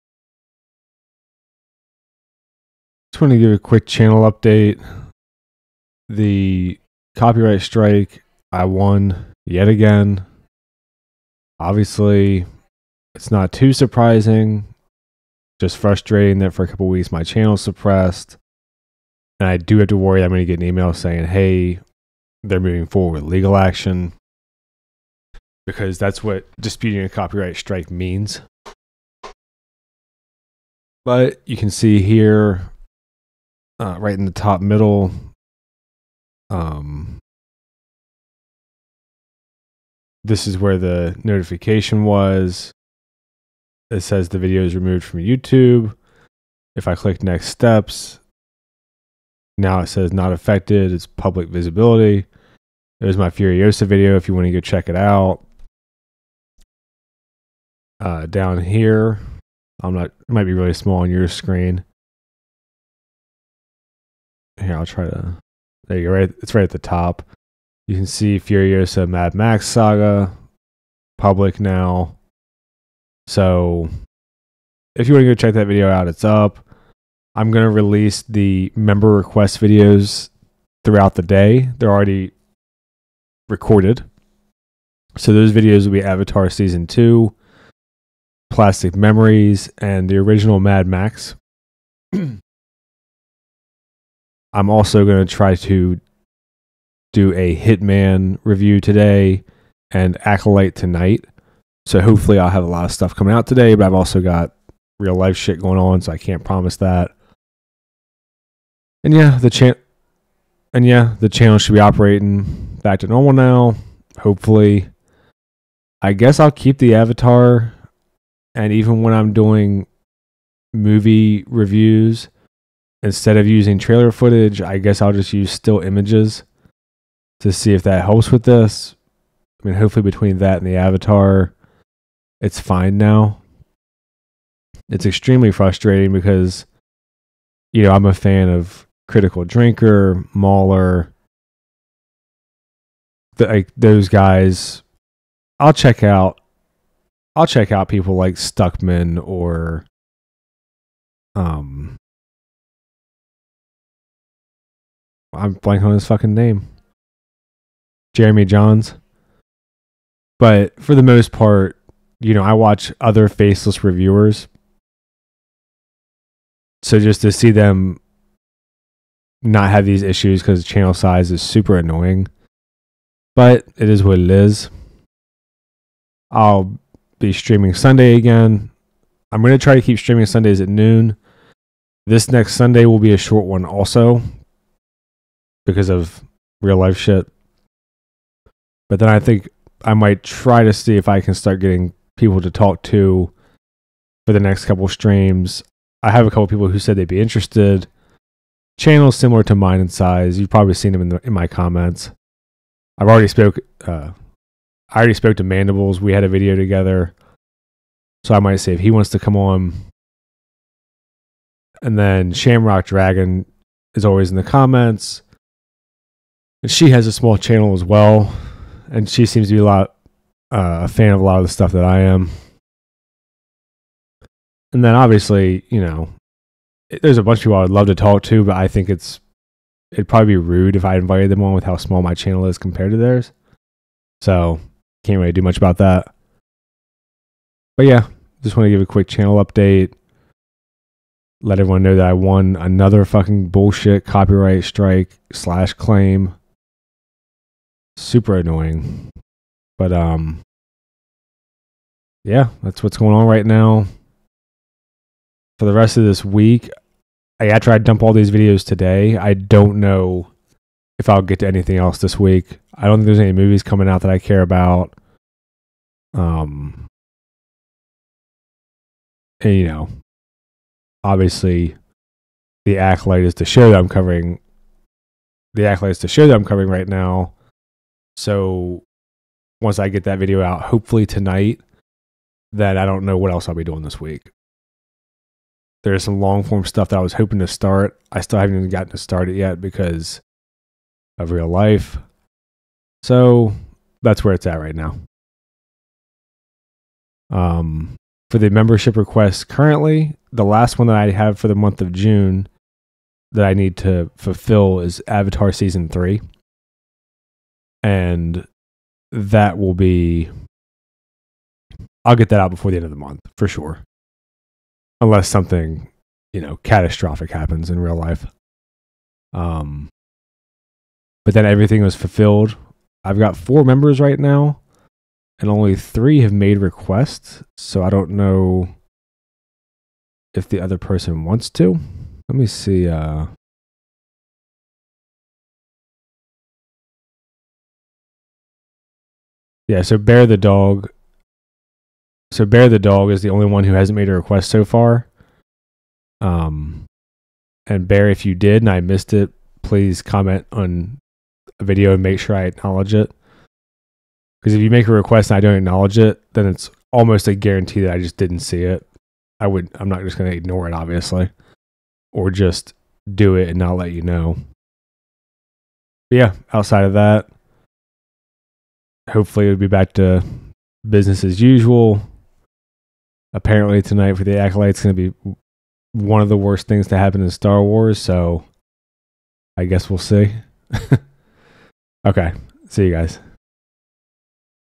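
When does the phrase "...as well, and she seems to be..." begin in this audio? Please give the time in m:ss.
3:37.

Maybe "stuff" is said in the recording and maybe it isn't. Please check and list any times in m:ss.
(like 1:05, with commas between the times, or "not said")
1:42, 3:41, 4:46.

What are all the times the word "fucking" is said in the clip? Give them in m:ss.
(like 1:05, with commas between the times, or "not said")
2:36, 4:03.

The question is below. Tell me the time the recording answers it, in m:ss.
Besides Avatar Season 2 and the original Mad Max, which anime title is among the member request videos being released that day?
1:28.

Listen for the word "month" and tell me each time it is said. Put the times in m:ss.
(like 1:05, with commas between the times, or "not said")
5:01, 5:12.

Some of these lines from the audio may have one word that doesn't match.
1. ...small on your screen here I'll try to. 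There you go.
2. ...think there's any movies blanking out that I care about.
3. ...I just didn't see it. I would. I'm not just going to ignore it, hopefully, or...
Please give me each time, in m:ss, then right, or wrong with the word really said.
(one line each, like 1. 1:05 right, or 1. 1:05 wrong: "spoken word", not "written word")
1. 1:00 right
2. 4:22 wrong: "coming", not "blanking"
3. 5:57 wrong: "obviously", not "hopefully".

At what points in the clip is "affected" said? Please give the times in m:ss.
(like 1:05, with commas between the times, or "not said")
0:50.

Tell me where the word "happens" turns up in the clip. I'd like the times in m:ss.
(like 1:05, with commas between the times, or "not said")
5:17, 6:16.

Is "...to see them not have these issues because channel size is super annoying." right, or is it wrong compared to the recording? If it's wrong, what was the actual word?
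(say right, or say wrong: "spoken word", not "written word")
right.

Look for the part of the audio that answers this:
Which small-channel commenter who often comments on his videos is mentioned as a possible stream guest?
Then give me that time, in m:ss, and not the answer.
3:32.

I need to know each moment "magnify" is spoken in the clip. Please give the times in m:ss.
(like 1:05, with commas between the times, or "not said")
not said.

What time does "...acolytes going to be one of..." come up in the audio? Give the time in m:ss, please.
6:14.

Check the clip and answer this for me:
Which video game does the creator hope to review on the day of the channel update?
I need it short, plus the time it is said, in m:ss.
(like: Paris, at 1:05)
Hitman, at 1:37.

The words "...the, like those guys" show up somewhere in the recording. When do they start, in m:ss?
2:23.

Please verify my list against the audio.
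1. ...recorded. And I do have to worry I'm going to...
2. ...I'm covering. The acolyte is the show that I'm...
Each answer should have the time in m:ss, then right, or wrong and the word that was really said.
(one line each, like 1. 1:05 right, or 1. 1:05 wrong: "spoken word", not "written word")
1. 0:17 wrong: "suppressed", not "recorded"
2. 4:33 right.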